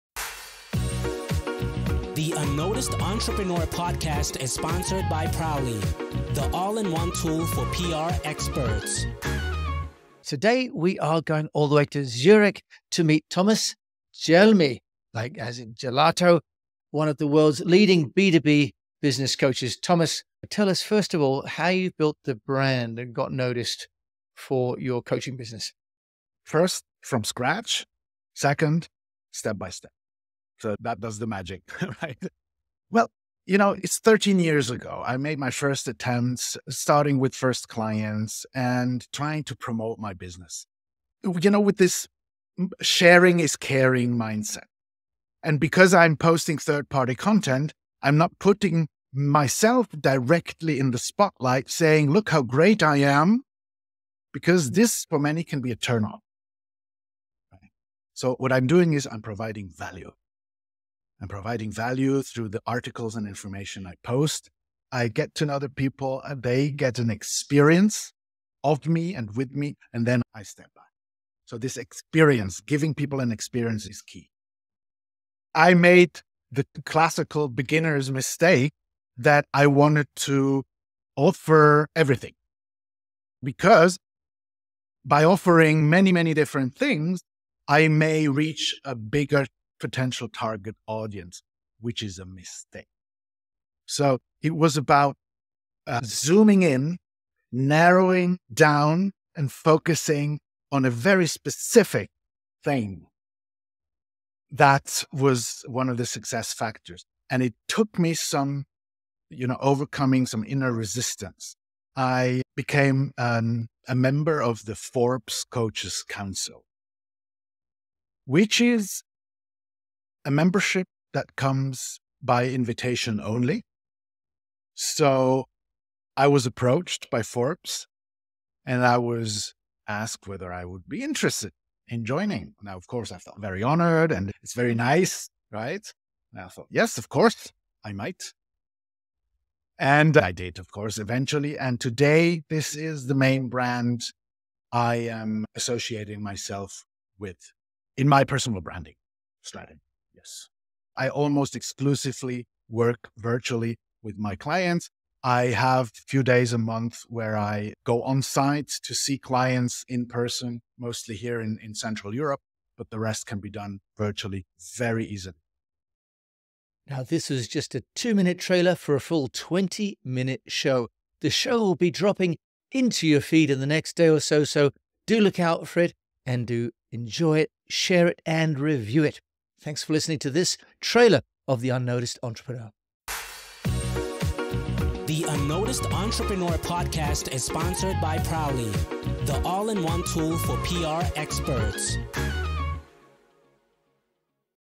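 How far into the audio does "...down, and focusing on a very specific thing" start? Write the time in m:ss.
1:38.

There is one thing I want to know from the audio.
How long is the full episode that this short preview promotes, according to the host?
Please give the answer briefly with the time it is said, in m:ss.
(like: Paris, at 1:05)
20 minutes, at 2:49.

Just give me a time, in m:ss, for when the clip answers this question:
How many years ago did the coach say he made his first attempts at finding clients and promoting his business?
0:33.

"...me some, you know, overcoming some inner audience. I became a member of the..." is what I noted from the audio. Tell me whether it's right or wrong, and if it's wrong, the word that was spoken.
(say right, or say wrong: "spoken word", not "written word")
wrong: "resistance", not "audience".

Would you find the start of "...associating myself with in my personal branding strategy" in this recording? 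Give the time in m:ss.
2:25.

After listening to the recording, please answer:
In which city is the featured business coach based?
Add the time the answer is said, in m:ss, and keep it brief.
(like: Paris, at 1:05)
Zurich, at 0:12.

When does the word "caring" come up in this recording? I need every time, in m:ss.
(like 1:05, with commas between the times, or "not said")
0:43.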